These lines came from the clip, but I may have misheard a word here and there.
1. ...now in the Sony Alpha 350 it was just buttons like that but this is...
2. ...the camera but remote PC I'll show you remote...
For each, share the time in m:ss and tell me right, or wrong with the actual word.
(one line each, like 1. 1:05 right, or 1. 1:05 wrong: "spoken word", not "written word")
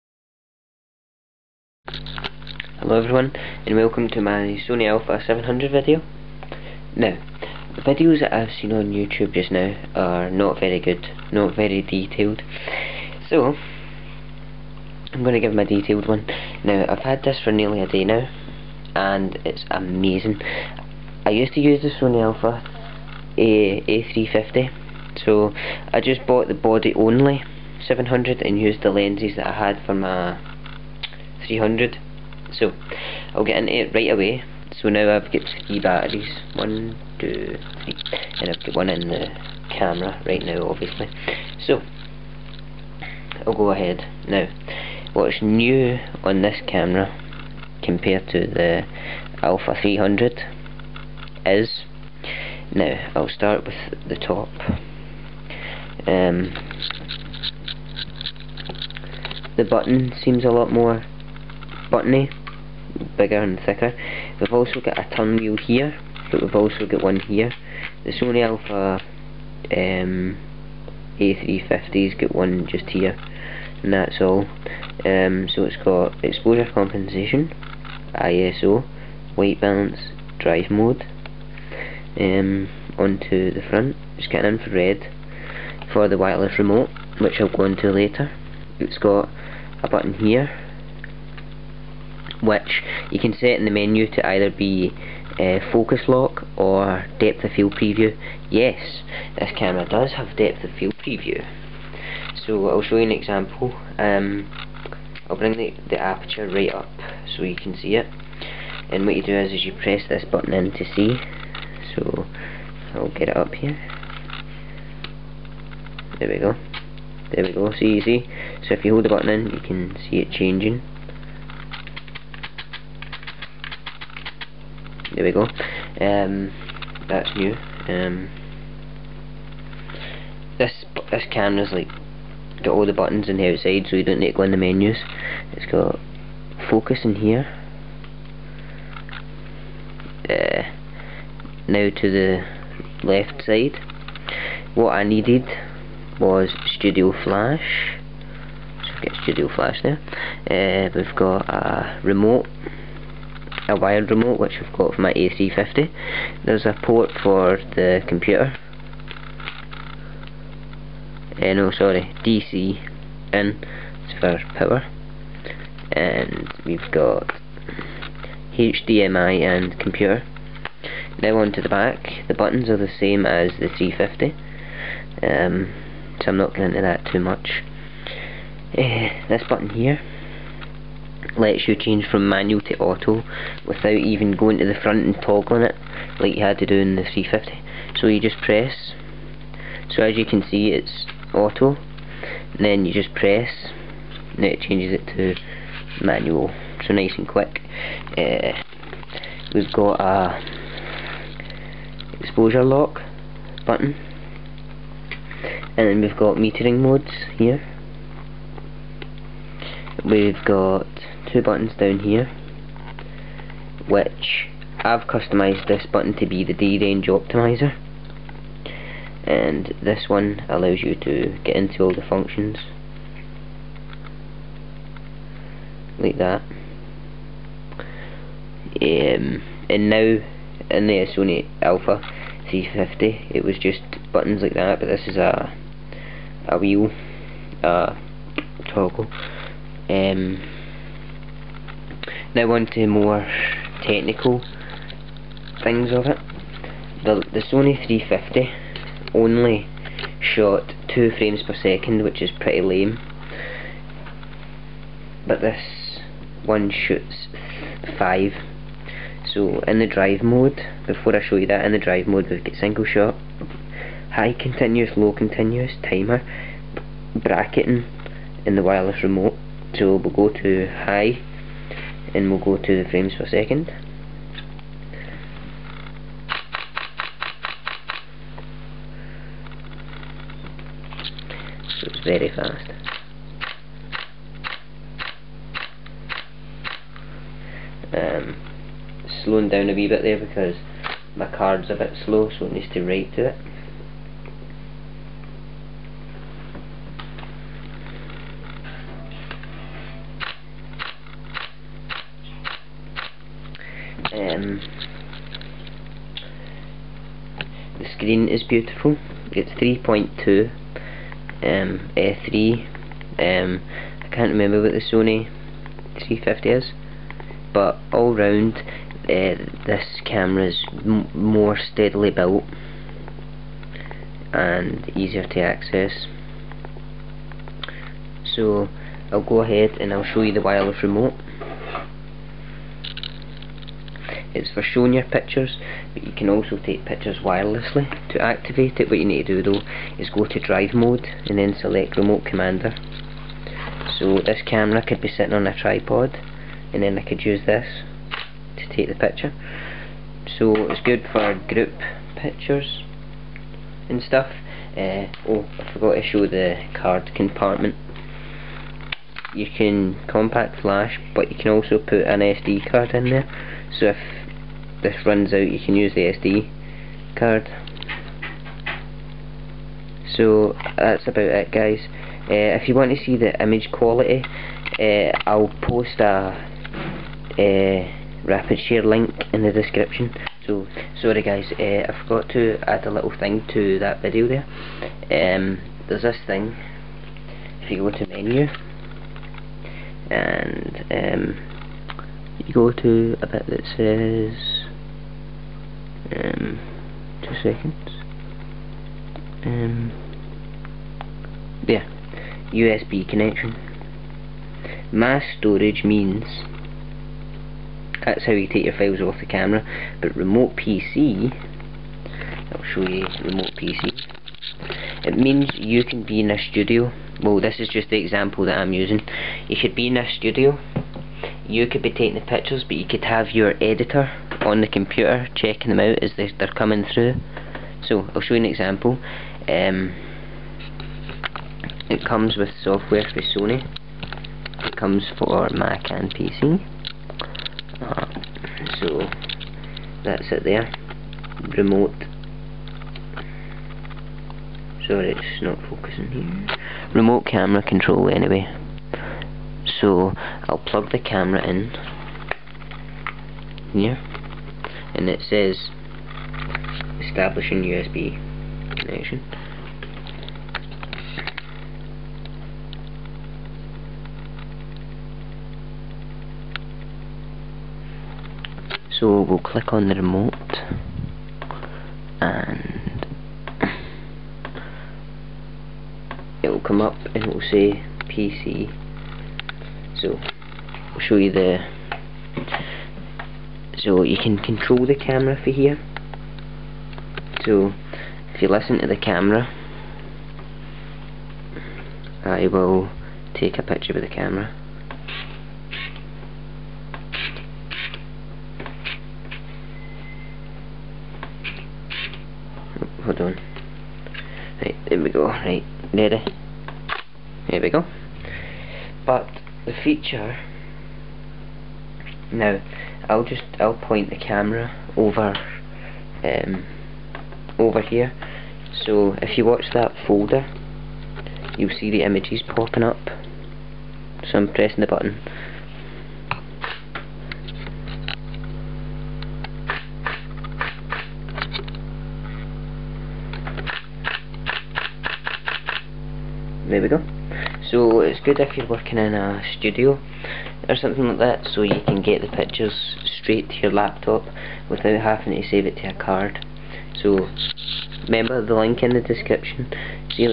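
1. 3:49 right
2. 6:49 right.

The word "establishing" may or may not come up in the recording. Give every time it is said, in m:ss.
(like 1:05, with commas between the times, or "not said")
7:37.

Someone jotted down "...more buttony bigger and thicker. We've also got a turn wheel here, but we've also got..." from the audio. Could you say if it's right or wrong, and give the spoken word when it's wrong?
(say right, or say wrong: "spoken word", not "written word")
right.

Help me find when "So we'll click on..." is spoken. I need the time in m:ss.
7:48.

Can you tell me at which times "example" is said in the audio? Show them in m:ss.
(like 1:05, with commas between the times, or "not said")
1:43, 6:57, 7:08.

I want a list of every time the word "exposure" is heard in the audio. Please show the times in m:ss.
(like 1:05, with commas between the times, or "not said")
1:16, 3:22.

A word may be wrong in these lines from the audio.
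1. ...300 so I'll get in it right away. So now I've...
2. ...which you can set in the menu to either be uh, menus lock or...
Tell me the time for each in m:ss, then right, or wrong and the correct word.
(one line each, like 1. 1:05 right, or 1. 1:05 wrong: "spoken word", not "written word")
1. 0:31 right
2. 1:32 wrong: "focus", not "menus".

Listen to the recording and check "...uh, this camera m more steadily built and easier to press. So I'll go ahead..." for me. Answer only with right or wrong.
wrong.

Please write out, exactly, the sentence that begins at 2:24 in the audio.
What I needed was Studio Flash.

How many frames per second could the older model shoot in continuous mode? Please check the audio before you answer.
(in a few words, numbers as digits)
2.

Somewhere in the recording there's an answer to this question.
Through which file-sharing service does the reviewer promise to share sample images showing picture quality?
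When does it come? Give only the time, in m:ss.
6:18.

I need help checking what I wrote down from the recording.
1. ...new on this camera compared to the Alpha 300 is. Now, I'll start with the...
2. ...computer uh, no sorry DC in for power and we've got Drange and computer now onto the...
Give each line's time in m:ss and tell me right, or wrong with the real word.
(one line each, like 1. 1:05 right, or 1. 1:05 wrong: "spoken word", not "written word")
1. 0:45 right
2. 2:38 wrong: "HDMI", not "Drange".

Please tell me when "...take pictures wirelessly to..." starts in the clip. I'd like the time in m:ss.
5:36.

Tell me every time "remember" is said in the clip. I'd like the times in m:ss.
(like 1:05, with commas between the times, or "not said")
5:14, 9:08.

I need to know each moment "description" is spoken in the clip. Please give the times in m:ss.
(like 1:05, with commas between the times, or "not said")
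6:19, 9:09.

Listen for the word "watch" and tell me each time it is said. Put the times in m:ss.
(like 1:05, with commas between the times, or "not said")
8:39.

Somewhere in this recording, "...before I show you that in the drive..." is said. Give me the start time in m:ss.
4:20.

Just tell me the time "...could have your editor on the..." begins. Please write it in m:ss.
7:02.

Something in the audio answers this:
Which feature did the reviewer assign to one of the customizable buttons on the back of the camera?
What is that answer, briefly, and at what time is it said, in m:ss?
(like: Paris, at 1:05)
D-range optimizer, at 3:36.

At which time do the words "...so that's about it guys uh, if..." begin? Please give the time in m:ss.
6:10.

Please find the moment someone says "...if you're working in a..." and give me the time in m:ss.
8:58.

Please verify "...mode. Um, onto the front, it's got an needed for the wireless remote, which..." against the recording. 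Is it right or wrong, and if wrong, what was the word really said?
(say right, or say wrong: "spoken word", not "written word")
wrong: "infrared", not "needed".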